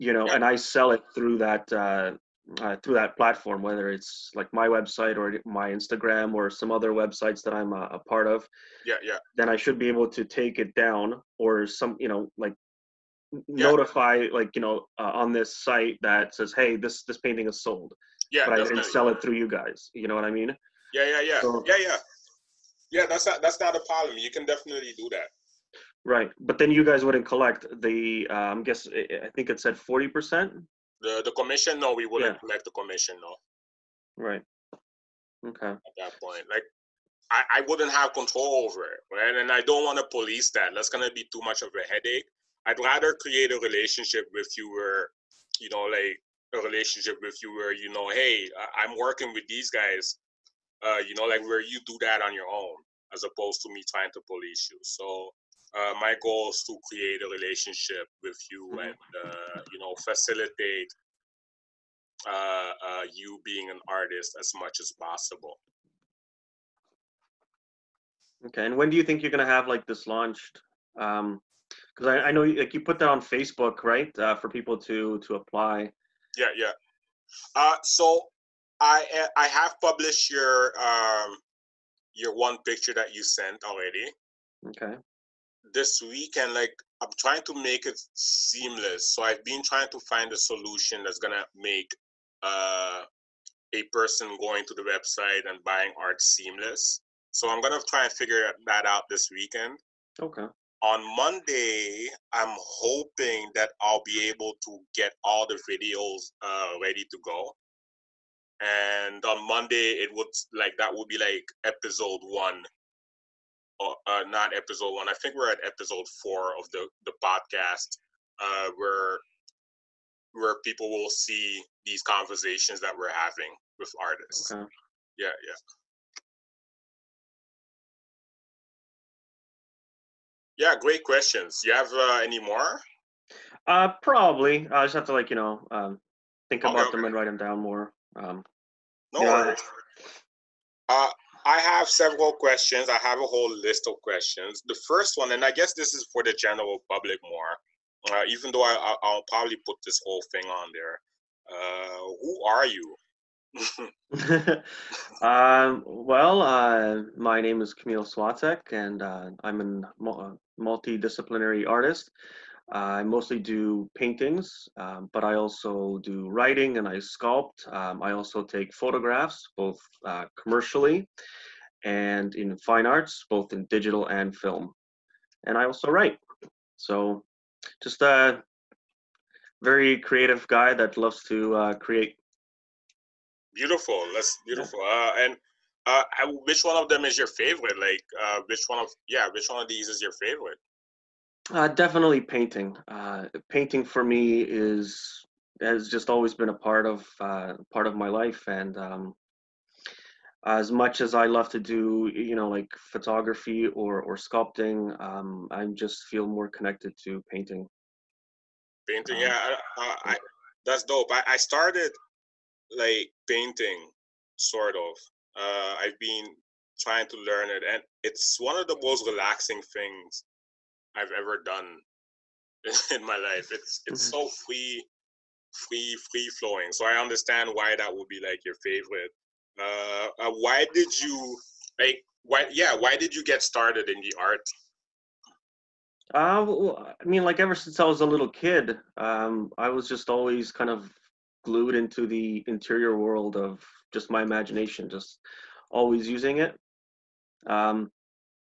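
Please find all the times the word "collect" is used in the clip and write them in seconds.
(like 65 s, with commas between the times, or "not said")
27 s, 32 s.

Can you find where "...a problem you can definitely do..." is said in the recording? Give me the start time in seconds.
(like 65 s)
23 s.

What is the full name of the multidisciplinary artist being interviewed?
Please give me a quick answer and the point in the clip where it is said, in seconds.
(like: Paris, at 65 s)
Kamil Swiatek, at 157 s.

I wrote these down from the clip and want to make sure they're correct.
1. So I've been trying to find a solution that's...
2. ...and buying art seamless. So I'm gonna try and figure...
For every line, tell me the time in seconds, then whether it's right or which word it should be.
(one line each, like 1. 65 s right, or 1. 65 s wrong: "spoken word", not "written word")
1. 89 s right
2. 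95 s right.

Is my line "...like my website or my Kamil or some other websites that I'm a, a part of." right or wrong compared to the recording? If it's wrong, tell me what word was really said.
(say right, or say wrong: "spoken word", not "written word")
wrong: "Instagram", not "Kamil".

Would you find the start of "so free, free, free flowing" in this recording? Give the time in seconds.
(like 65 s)
224 s.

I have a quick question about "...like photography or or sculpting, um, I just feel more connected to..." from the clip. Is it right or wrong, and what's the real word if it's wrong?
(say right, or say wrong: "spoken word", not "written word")
right.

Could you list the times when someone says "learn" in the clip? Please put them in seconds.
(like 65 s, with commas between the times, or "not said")
217 s.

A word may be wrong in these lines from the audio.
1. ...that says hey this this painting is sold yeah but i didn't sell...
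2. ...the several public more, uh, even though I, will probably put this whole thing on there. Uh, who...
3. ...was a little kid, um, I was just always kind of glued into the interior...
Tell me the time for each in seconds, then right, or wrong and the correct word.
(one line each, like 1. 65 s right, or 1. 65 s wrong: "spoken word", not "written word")
1. 16 s right
2. 146 s wrong: "general", not "several"
3. 237 s right.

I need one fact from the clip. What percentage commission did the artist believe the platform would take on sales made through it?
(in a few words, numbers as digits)
40 percent.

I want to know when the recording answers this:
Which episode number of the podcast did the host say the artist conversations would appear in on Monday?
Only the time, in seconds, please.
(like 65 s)
115 s.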